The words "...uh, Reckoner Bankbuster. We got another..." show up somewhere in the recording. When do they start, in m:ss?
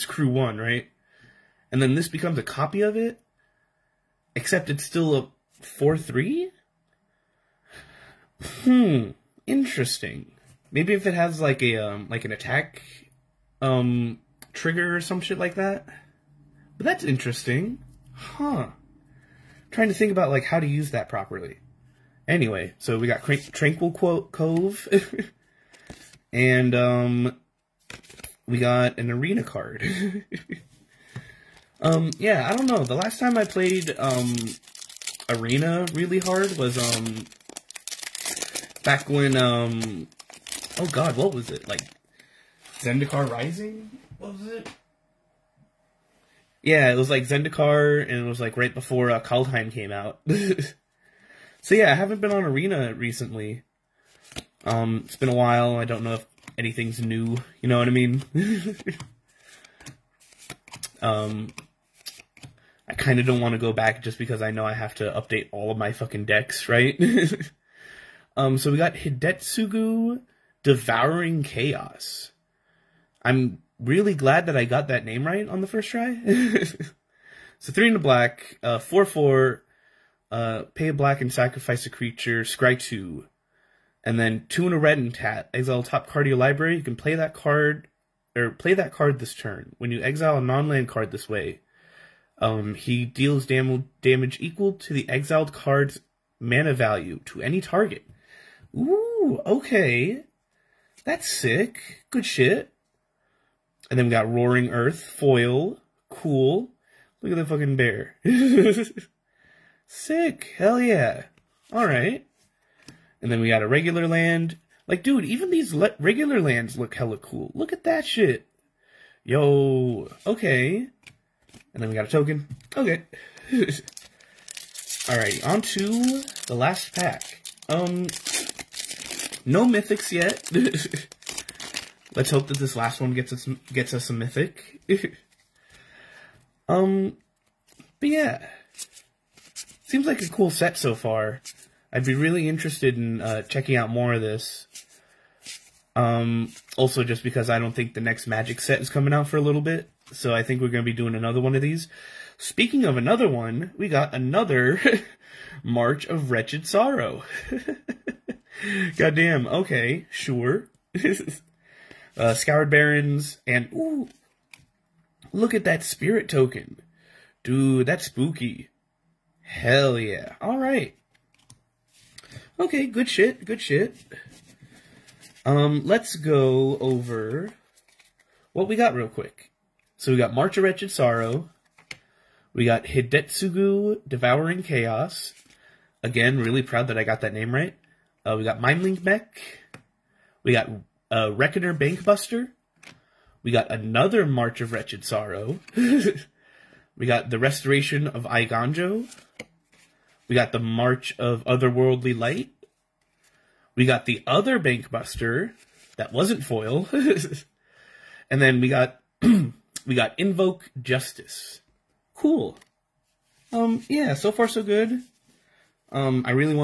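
3:11.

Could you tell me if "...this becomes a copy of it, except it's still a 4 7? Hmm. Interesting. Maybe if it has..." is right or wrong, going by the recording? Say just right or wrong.
wrong.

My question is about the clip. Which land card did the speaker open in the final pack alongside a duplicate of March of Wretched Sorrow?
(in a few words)
Scoured Barrens.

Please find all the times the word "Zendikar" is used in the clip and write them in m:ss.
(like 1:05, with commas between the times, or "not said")
0:42, 0:47.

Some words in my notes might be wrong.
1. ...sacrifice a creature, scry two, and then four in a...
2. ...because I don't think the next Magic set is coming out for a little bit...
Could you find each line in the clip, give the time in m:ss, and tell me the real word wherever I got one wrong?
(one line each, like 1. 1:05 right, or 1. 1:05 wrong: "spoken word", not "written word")
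1. 1:21 wrong: "two", not "four"
2. 2:27 right.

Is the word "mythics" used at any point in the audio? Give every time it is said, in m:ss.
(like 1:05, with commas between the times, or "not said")
2:09, 2:14.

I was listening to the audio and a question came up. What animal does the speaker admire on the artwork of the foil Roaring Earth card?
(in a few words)
Bear.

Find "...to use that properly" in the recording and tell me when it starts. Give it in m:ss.
0:20.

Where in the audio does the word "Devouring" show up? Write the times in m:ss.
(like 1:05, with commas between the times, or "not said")
1:10, 3:04.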